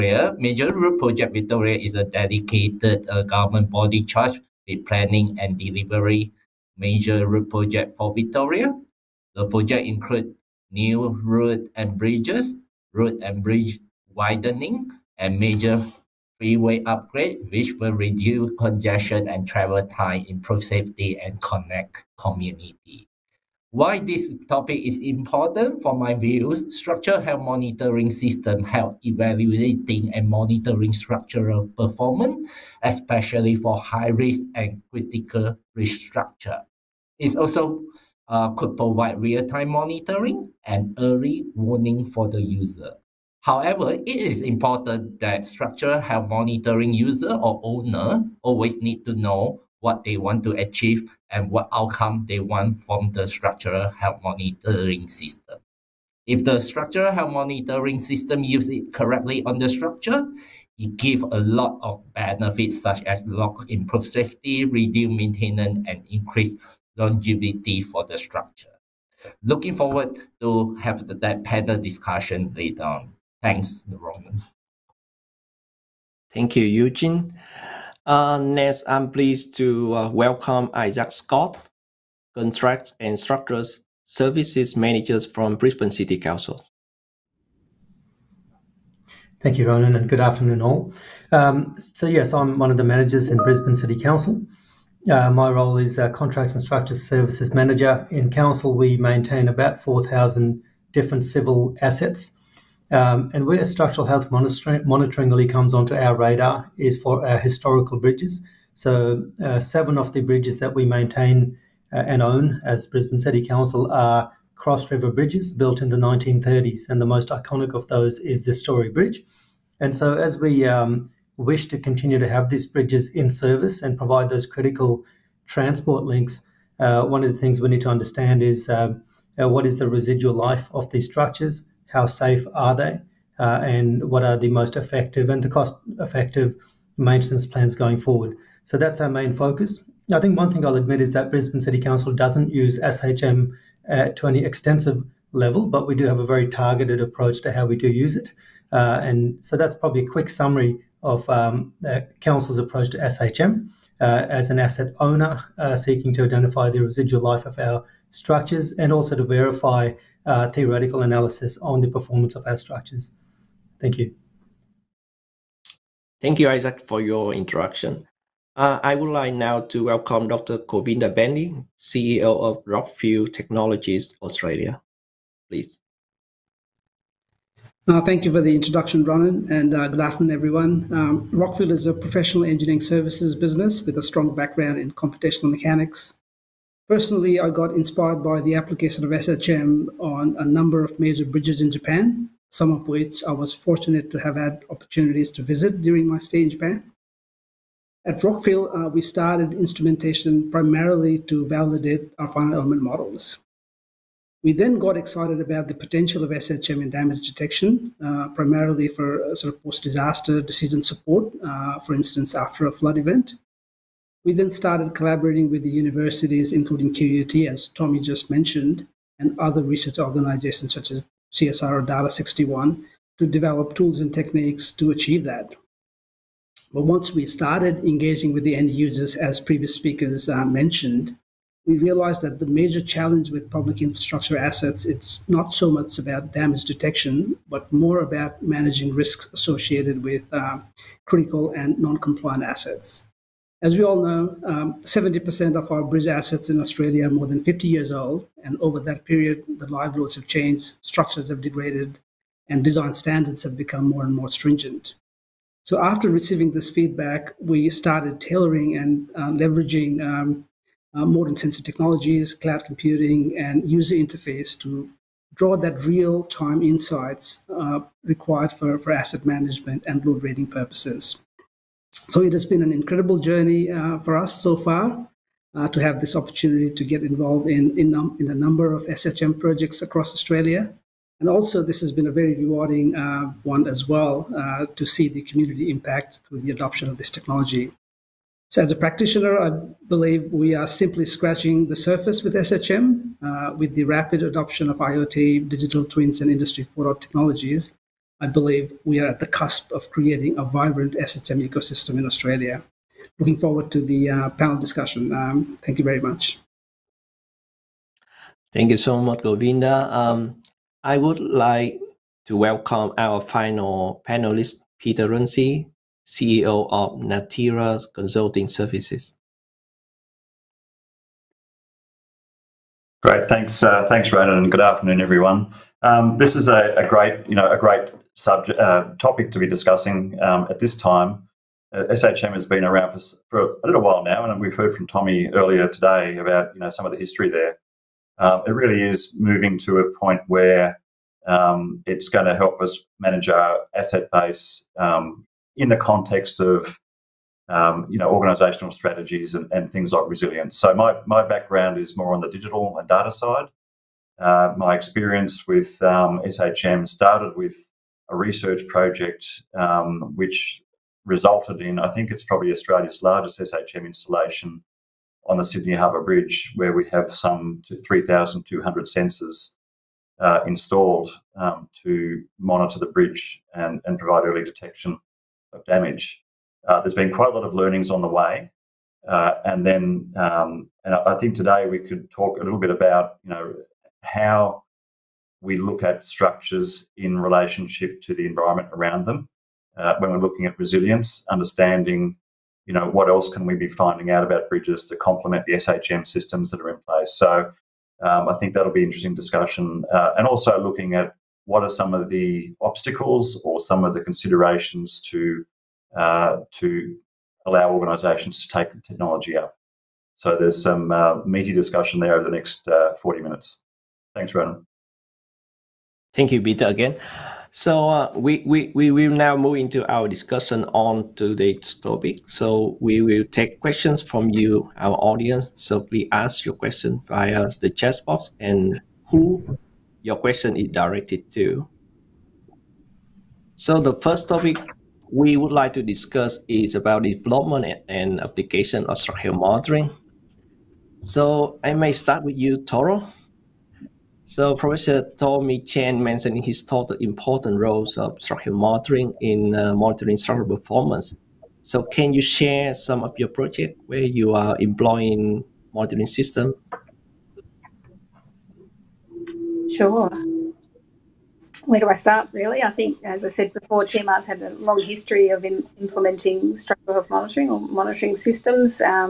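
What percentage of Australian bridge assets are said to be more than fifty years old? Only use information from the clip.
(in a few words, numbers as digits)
70%.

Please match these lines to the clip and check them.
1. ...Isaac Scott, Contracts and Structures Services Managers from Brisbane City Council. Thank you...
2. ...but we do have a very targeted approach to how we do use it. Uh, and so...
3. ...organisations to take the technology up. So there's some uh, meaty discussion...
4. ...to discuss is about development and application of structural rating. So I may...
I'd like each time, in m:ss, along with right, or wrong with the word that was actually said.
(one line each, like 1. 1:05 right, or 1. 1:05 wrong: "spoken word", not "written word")
1. 1:20 right
2. 2:25 right
3. 6:47 right
4. 7:15 wrong: "monitoring", not "rating".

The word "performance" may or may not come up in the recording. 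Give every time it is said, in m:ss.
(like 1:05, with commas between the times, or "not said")
0:31, 2:41, 7:30.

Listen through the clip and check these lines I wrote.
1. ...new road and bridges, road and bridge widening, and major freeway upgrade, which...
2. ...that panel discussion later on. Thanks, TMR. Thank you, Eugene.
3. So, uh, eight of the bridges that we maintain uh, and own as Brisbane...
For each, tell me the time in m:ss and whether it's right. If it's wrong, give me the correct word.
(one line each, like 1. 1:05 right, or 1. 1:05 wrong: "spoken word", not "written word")
1. 0:10 right
2. 1:11 wrong: "Ronan", not "TMR"
3. 1:48 wrong: "seven", not "eight".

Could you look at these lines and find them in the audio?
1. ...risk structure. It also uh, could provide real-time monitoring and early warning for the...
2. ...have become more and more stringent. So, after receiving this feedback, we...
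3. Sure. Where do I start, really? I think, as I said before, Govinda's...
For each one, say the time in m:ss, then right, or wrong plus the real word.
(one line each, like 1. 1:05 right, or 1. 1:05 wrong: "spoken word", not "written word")
1. 0:35 right
2. 4:13 right
3. 7:39 wrong: "TMR", not "Govinda".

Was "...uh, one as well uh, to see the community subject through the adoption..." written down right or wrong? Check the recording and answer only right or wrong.
wrong.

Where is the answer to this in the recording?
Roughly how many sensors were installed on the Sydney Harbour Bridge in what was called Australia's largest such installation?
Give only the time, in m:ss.
6:07.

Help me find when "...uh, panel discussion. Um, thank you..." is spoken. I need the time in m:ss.
5:04.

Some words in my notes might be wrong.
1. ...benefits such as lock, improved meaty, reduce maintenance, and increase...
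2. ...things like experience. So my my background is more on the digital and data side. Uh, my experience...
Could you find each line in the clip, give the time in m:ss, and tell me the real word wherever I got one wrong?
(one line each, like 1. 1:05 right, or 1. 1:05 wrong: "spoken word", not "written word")
1. 1:02 wrong: "safety", not "meaty"
2. 5:49 wrong: "resilience", not "experience".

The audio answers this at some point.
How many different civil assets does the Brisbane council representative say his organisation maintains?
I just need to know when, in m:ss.
1:39.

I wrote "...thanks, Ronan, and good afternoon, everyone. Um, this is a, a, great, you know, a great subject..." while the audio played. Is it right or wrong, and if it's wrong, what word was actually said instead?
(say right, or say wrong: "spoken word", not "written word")
right.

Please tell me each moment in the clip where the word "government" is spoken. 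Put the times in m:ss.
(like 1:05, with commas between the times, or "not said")
0:03.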